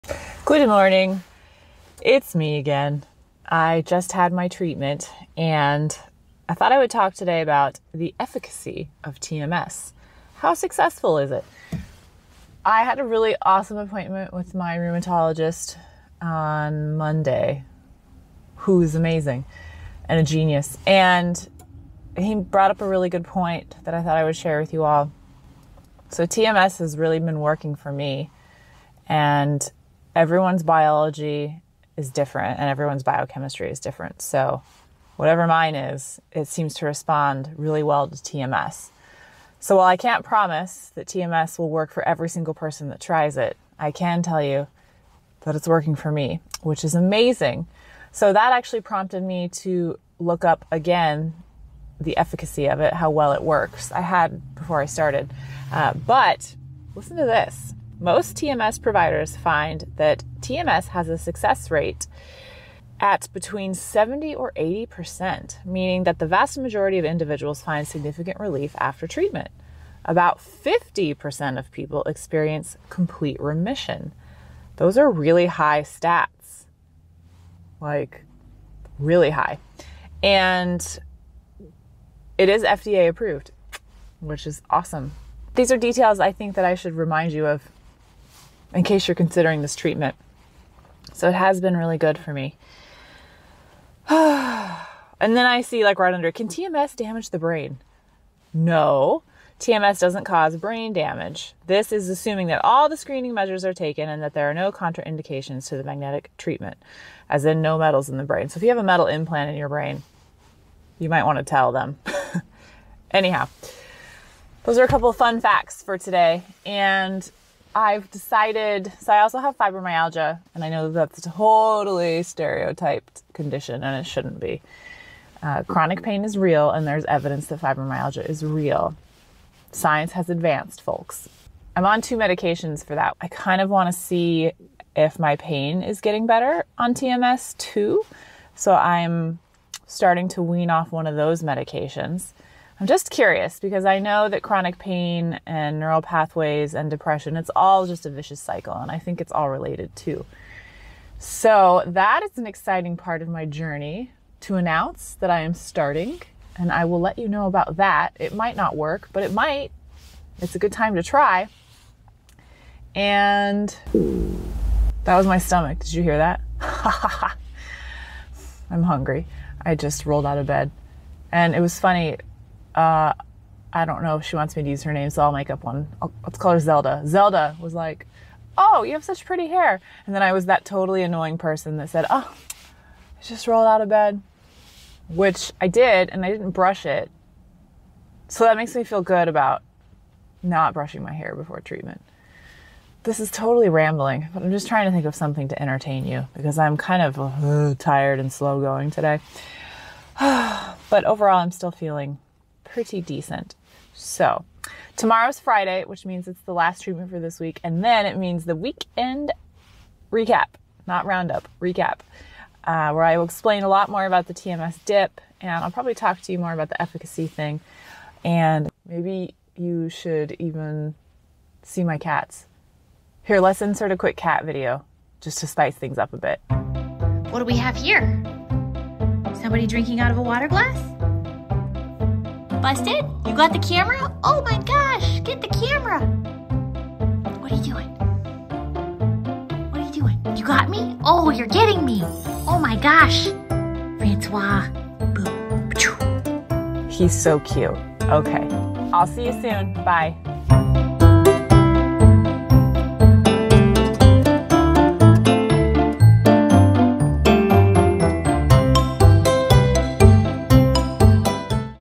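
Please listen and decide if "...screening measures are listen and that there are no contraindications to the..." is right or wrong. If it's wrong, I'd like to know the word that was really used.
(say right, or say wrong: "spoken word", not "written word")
wrong: "taken", not "listen".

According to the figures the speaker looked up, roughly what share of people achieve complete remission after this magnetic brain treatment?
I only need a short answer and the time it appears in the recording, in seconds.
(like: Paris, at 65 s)
50%, at 70 s.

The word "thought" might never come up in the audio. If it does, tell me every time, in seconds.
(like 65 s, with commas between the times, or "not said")
6 s, 24 s.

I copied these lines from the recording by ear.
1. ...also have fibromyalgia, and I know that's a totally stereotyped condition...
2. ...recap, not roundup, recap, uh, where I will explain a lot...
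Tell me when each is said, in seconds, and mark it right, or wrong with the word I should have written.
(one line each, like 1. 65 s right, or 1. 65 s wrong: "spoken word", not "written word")
1. 119 s right
2. 210 s right.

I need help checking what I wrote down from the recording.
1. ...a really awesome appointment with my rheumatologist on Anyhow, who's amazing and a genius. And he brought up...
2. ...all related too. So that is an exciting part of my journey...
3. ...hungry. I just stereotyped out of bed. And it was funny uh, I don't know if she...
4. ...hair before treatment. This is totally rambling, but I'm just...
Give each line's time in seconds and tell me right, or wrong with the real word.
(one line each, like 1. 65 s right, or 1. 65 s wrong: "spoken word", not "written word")
1. 12 s wrong: "Monday", not "Anyhow"
2. 149 s right
3. 168 s wrong: "rolled", not "stereotyped"
4. 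191 s right.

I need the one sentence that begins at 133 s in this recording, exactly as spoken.
I kind of want to see if my pain is getting better on TMS too.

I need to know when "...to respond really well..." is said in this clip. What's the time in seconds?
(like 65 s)
36 s.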